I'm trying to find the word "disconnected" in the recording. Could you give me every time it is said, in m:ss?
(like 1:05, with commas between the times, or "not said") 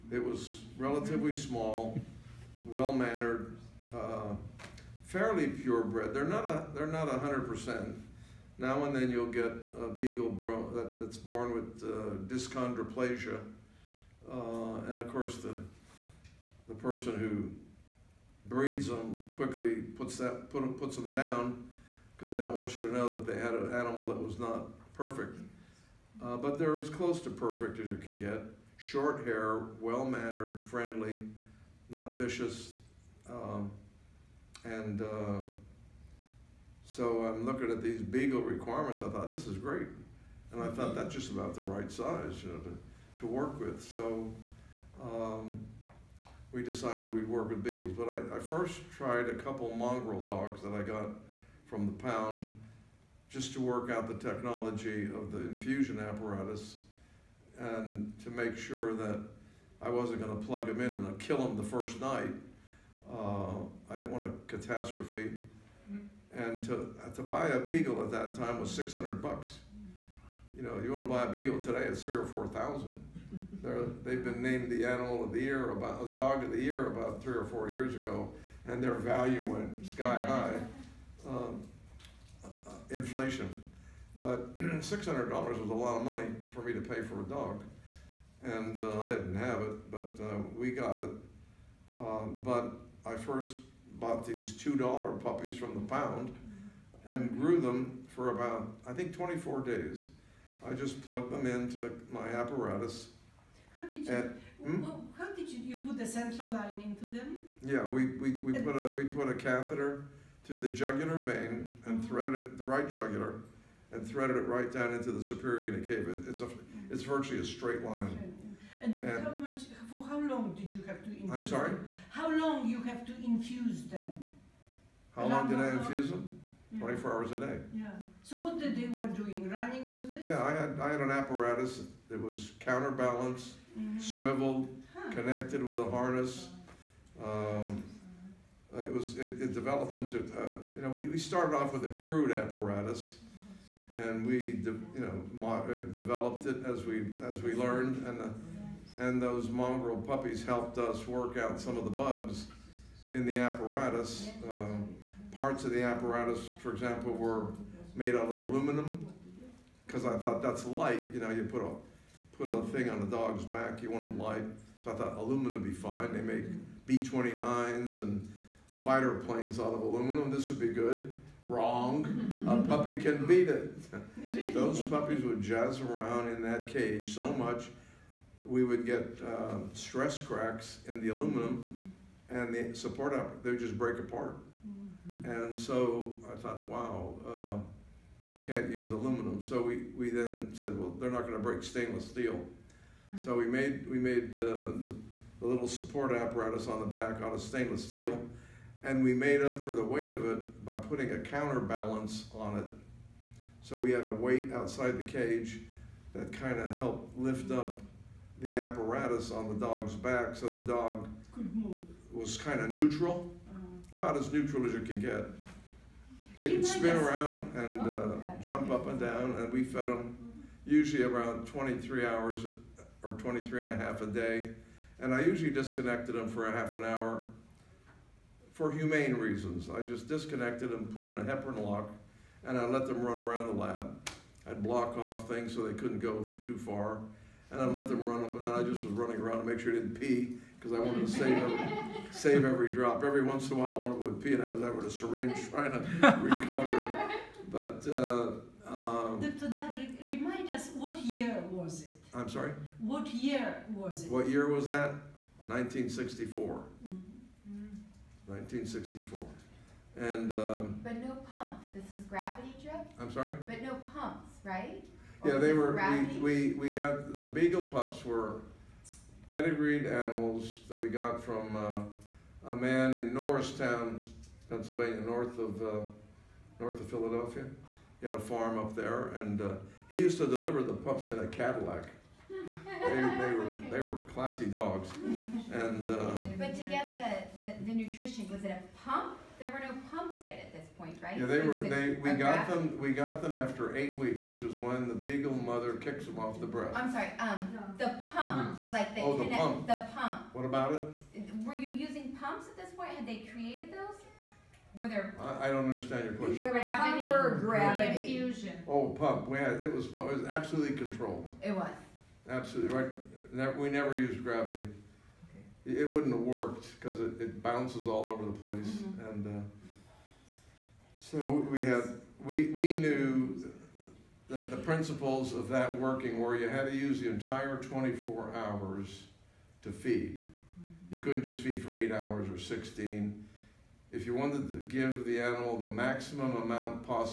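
3:45, 3:50.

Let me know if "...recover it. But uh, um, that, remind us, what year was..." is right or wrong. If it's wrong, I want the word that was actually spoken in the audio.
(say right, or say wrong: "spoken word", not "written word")
right.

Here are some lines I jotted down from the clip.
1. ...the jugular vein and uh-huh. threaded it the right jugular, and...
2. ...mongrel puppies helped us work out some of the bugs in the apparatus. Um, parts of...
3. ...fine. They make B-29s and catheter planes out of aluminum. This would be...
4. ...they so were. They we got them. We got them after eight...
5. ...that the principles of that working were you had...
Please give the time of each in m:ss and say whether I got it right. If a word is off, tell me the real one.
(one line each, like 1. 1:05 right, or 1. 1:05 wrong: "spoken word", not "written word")
1. 1:50 right
2. 2:29 right
3. 2:45 wrong: "fighter", not "catheter"
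4. 4:51 right
5. 5:24 right.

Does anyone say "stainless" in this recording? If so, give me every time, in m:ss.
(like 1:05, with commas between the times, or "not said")
3:11, 3:17.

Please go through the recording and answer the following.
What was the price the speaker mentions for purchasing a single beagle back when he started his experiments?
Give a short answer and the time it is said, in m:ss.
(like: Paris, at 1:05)
$600, at 1:08.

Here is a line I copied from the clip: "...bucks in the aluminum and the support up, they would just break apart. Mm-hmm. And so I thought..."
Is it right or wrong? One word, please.
wrong.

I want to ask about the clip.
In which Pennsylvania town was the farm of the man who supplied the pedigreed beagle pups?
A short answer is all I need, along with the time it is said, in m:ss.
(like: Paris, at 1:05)
Norristown, at 4:33.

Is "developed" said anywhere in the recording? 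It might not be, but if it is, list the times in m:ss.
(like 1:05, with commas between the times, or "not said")
2:19, 2:25.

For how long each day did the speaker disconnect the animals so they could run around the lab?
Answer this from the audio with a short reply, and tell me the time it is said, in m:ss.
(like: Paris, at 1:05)
half an hour, at 3:46.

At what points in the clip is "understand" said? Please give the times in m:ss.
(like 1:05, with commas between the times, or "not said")
5:05.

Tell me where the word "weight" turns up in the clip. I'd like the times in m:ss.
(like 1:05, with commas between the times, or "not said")
3:19, 3:24.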